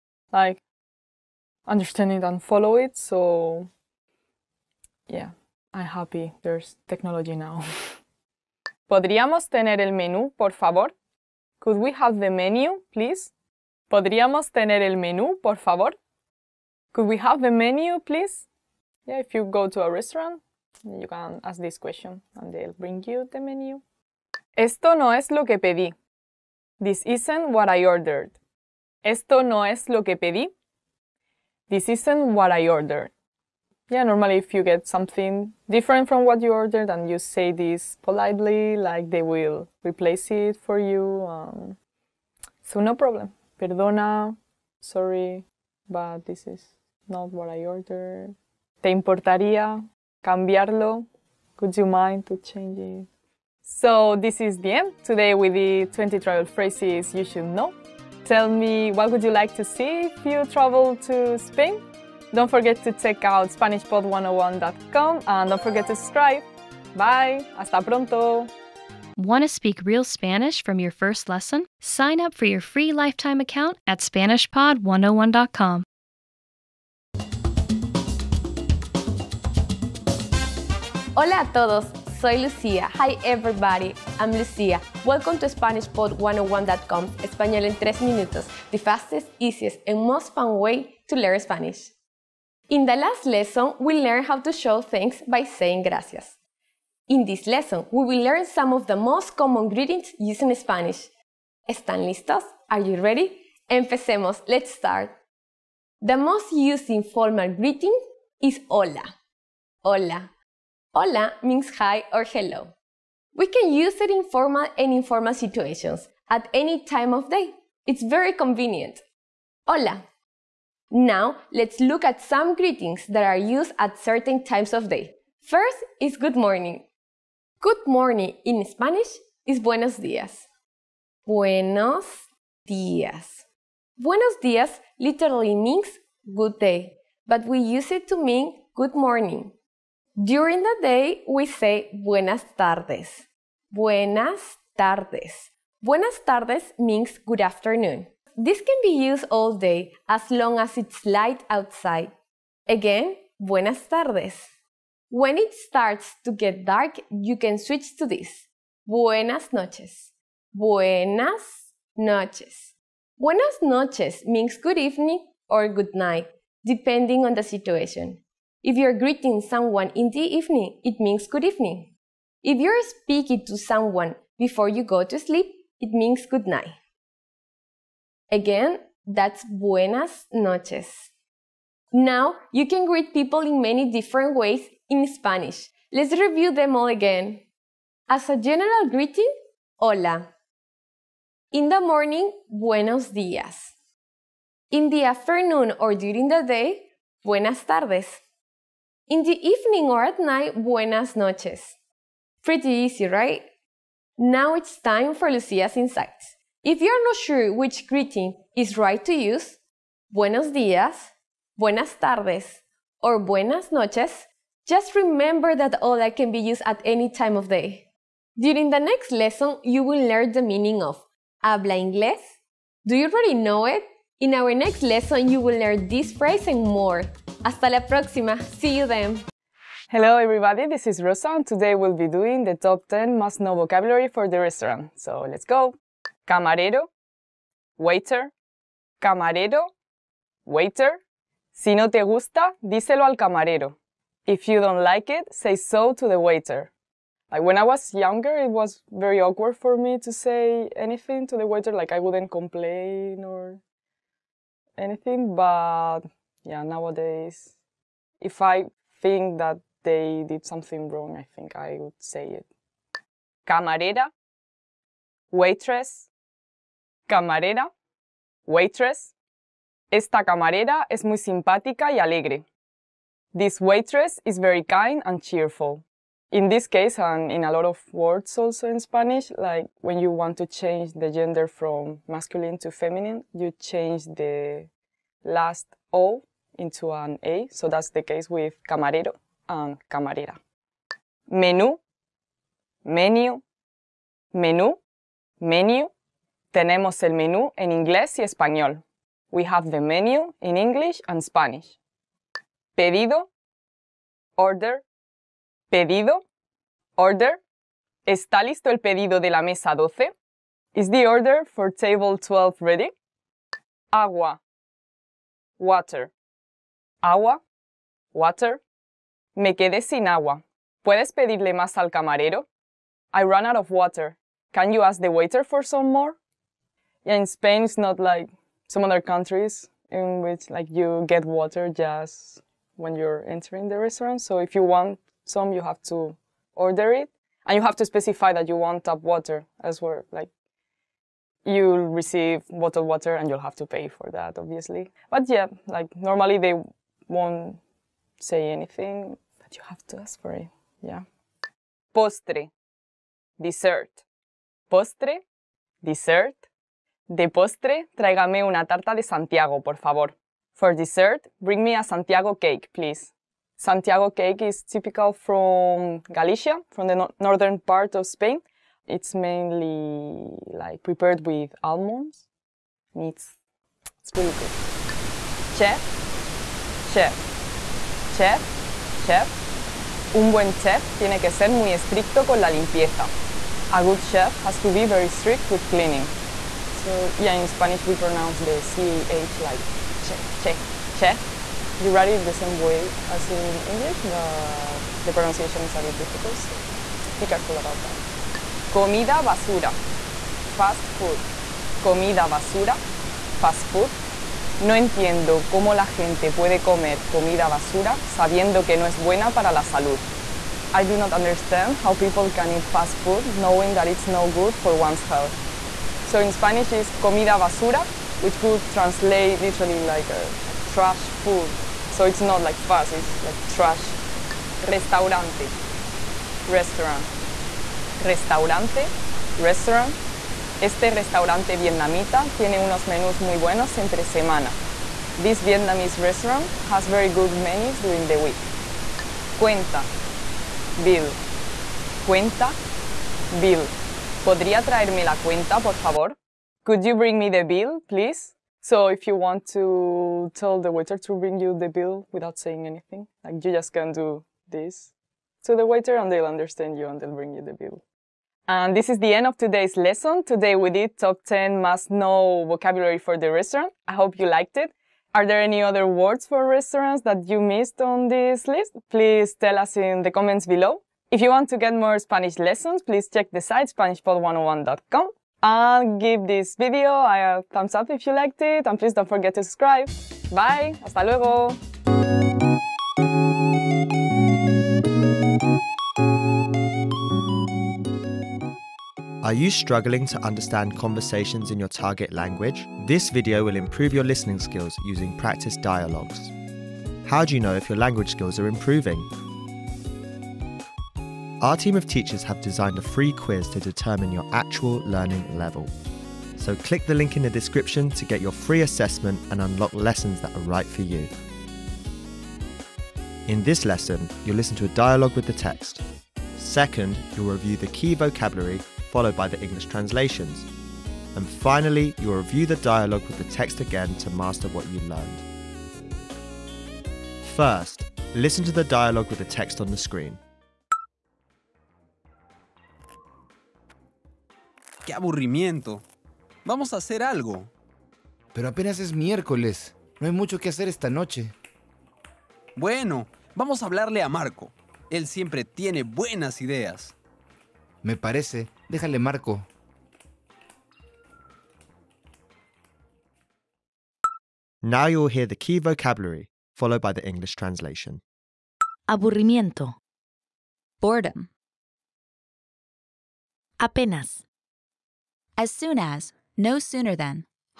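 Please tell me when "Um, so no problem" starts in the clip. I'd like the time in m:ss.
0:41.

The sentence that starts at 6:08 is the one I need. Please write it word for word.
It's mainly like prepared with almonds.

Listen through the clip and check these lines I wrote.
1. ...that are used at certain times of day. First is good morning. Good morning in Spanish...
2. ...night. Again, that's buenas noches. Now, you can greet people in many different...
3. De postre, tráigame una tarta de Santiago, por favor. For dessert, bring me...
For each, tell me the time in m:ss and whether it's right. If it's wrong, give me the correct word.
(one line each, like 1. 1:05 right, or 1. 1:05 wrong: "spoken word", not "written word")
1. 2:03 right
2. 2:56 right
3. 5:57 right.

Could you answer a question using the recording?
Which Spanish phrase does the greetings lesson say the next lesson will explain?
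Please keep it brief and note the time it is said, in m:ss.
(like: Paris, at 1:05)
habla inglés, at 3:41.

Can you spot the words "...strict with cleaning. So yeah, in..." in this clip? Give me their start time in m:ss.
6:25.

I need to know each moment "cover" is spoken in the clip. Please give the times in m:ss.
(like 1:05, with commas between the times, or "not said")
not said.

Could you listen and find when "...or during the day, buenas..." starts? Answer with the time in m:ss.
3:15.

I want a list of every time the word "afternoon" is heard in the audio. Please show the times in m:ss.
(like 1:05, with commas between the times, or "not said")
2:27, 3:15.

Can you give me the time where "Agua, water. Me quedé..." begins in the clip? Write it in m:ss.
5:17.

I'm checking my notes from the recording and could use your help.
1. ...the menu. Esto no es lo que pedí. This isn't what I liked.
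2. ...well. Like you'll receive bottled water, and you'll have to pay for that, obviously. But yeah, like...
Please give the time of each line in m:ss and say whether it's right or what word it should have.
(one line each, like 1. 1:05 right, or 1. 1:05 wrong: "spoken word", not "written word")
1. 0:23 wrong: "ordered", not "liked"
2. 5:39 right.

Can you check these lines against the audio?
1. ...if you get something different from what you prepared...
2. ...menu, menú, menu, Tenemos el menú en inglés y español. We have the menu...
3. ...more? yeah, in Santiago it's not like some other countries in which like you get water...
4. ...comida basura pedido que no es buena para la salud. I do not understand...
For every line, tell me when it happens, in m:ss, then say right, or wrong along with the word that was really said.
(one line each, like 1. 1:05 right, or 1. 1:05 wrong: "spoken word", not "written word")
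1. 0:34 wrong: "ordered", not "prepared"
2. 4:52 right
3. 5:25 wrong: "Spain", not "Santiago"
4. 6:47 wrong: "sabiendo", not "pedido".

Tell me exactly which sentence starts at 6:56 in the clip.
So in Spanish is comida basura, which could translate literally like a, uh, like trash food.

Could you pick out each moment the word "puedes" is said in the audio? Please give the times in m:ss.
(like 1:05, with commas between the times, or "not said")
5:20, 6:46.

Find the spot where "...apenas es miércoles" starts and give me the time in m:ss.
8:58.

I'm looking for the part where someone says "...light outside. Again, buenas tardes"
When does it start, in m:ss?
2:31.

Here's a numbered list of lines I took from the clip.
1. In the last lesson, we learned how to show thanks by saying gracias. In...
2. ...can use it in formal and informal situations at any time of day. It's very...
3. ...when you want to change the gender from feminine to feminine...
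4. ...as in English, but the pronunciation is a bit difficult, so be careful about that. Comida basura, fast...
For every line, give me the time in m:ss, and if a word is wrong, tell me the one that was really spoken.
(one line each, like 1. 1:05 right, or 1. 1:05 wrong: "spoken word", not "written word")
1. 1:32 right
2. 1:53 right
3. 4:39 wrong: "masculine", not "feminine"
4. 6:33 right.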